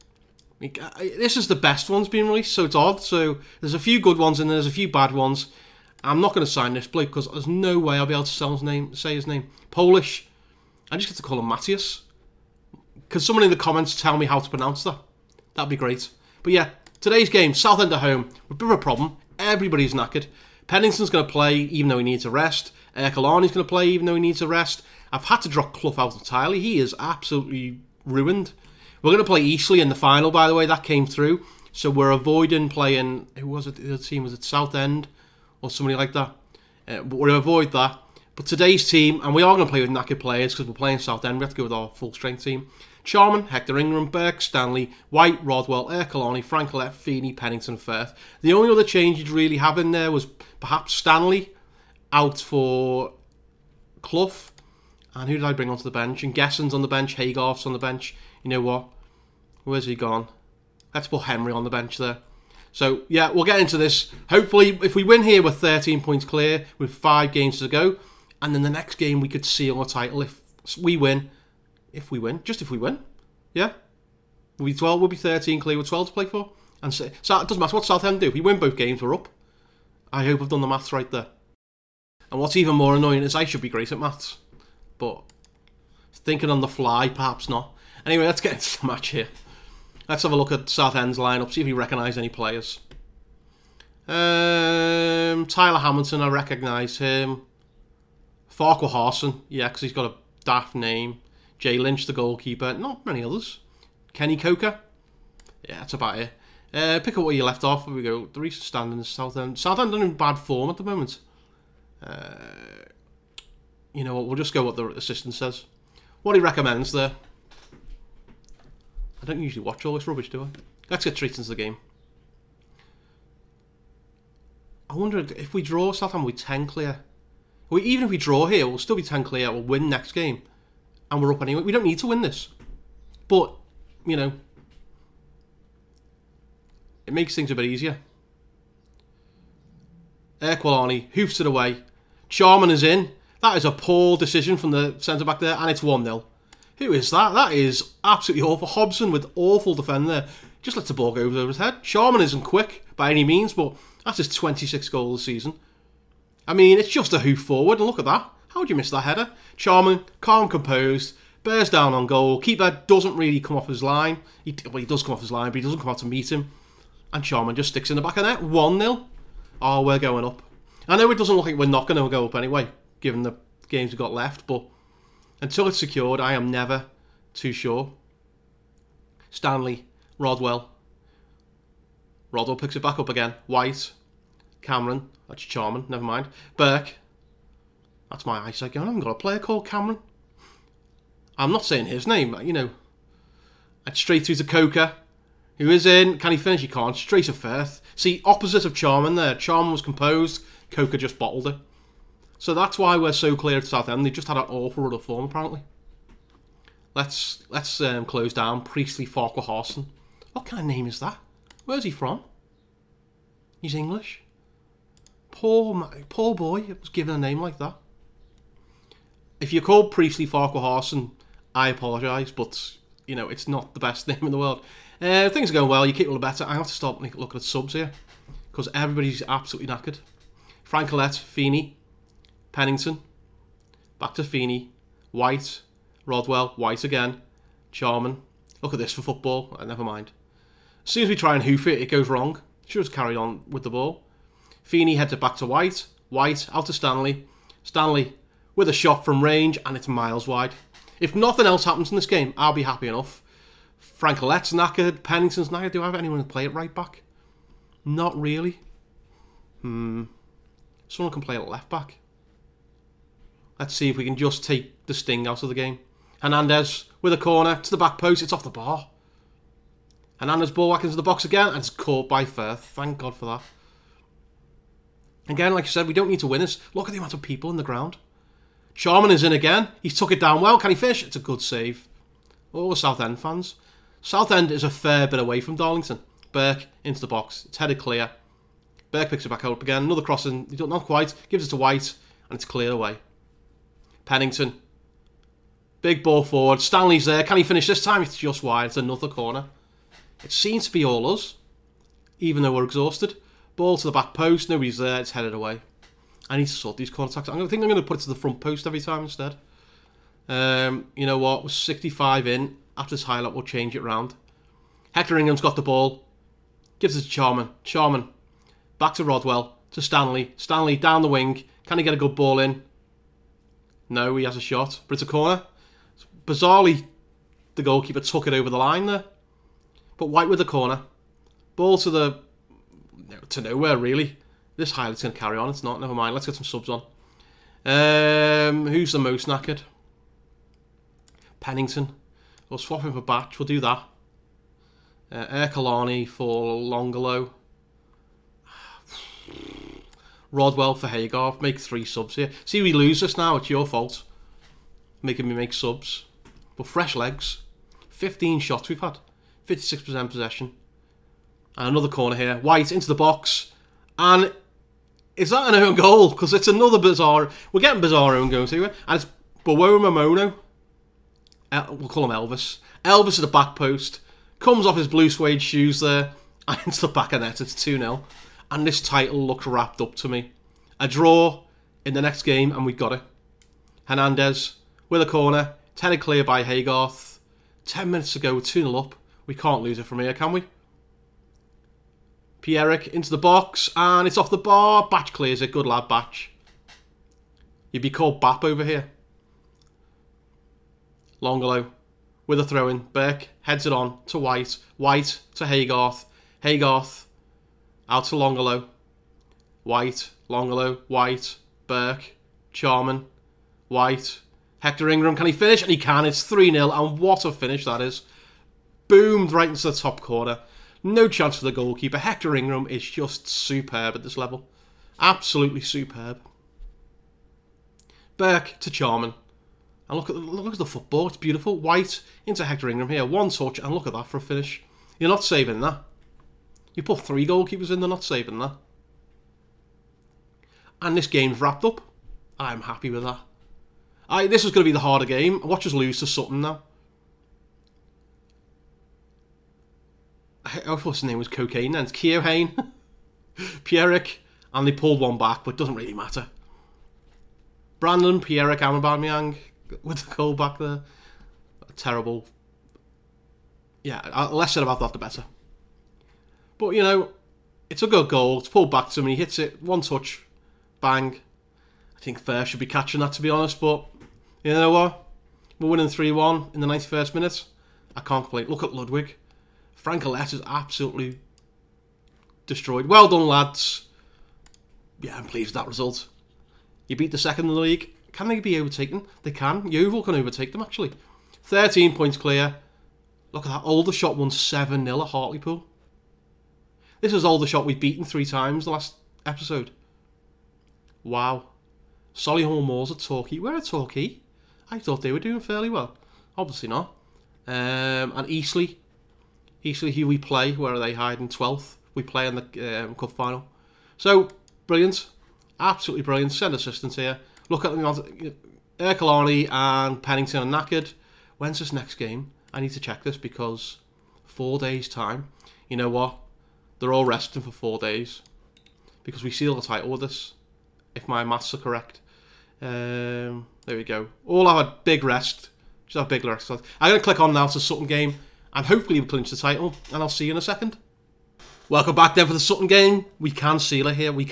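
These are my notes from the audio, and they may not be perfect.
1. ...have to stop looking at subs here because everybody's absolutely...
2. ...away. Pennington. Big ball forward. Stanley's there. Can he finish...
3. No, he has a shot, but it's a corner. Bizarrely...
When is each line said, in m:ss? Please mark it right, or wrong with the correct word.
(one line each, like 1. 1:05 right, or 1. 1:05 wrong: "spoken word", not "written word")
1. 3:46 right
2. 4:52 right
3. 5:23 right.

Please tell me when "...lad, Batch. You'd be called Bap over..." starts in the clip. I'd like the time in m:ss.
6:35.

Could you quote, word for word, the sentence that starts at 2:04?
I wonder if we draw Southampton, we 10 clear.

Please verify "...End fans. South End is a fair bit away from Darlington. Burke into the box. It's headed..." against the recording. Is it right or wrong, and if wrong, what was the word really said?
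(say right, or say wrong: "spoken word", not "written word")
right.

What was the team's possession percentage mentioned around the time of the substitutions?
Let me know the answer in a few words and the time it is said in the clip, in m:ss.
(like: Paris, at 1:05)
56%, at 5:59.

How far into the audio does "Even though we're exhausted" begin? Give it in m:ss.
5:02.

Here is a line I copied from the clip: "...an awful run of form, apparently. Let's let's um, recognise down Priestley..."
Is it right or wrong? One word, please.
wrong.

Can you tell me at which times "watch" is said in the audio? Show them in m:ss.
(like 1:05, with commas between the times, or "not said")
1:59, 7:25.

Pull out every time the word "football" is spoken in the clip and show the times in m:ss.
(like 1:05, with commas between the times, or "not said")
3:59, 7:10.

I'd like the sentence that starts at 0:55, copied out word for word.
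And who did I bring onto the bench?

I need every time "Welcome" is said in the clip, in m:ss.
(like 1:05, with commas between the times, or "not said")
9:01.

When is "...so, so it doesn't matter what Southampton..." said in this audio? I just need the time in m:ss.
1:16.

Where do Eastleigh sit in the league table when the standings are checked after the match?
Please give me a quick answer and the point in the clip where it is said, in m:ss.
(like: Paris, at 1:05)
12th, at 8:31.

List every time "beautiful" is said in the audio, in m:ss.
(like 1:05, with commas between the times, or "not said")
7:11.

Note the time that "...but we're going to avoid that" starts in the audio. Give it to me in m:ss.
0:37.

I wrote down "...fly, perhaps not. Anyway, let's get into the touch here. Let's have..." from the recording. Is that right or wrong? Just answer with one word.
wrong.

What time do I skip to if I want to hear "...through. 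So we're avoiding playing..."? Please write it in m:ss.
0:31.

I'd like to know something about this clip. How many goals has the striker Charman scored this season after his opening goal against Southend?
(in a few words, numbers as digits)
26.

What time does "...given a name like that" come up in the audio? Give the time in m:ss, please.
3:36.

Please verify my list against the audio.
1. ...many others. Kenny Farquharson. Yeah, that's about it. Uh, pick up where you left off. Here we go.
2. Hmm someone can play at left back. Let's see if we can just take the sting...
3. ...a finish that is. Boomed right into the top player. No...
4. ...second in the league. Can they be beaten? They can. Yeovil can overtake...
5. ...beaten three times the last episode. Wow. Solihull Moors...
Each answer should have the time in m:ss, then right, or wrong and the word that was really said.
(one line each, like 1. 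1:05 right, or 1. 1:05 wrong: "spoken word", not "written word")
1. 1:43 wrong: "Coker", not "Farquharson"
2. 4:19 right
3. 6:57 wrong: "corner", not "player"
4. 8:07 wrong: "overtaken", not "beaten"
5. 8:17 right.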